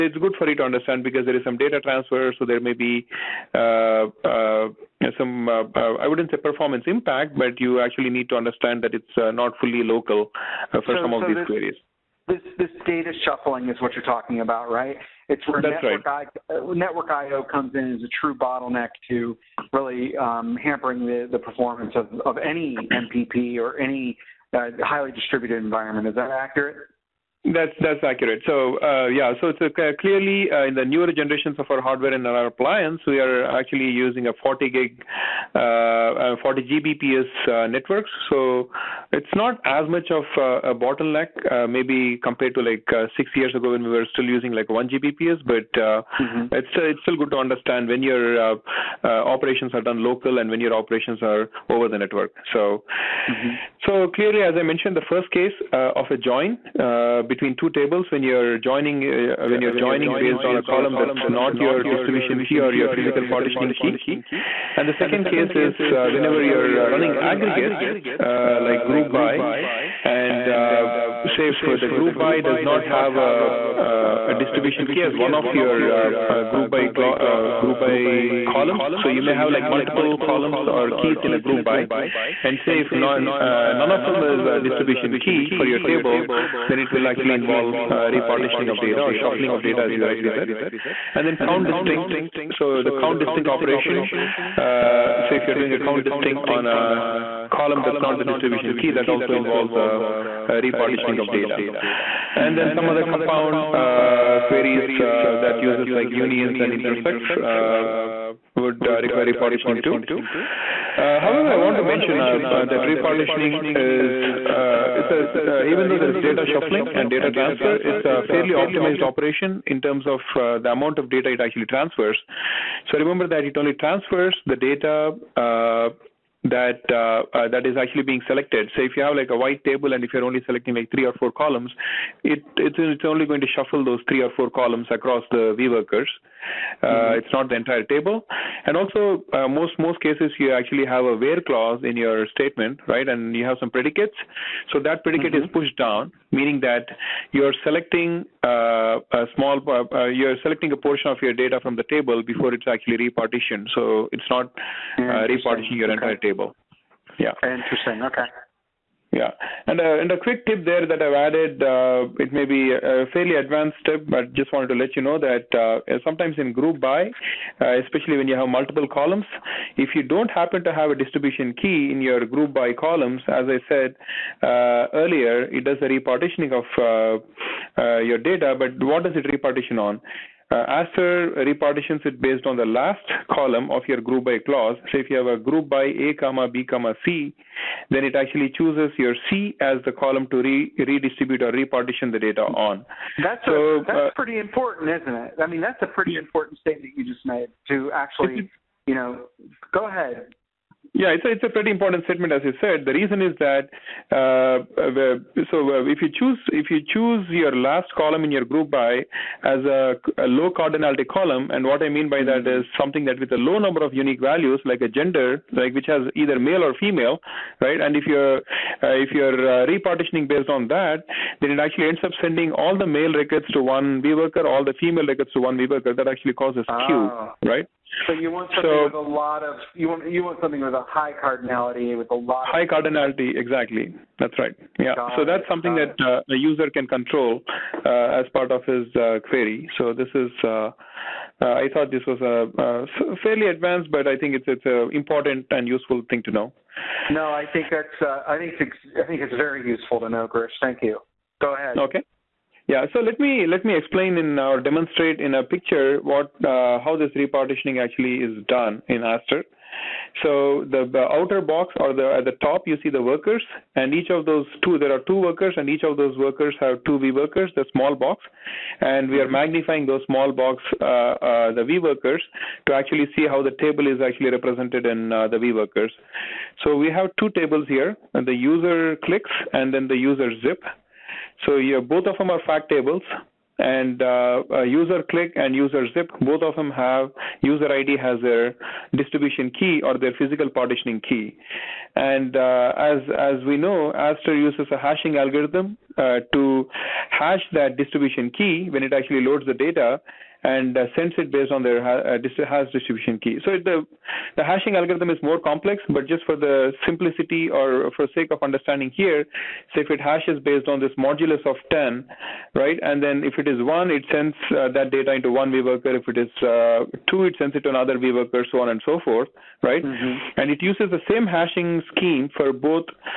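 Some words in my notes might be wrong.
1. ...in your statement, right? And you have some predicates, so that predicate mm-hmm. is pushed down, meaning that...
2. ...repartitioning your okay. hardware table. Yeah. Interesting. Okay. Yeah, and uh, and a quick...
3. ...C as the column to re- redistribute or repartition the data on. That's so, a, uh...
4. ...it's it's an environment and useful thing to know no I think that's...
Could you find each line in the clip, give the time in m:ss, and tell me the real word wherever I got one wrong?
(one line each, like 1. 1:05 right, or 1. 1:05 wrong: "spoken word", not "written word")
1. 2:21 right
2. 2:35 wrong: "entire", not "hardware"
3. 3:09 right
4. 4:04 wrong: "important", not "environment".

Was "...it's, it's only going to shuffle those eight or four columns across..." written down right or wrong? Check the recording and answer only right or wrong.
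wrong.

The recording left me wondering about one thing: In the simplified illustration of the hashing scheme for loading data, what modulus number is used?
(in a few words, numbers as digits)
10.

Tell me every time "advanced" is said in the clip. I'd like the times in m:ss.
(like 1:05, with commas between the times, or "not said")
2:43, 4:03.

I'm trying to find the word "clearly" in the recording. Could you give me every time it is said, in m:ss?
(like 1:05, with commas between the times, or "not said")
0:29, 0:54.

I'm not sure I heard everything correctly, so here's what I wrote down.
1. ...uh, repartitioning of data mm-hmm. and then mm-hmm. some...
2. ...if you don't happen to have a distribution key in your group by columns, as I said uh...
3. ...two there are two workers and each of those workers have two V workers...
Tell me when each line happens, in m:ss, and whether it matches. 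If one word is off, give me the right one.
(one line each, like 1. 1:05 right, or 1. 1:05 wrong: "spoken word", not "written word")
1. 1:40 right
2. 2:49 right
3. 4:24 right.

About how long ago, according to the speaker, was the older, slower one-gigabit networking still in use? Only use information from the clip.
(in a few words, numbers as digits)
6 years ago.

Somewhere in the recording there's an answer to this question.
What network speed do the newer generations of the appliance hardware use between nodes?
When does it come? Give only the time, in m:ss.
0:36.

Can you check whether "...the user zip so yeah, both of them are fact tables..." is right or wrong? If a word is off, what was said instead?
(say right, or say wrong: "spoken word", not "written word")
right.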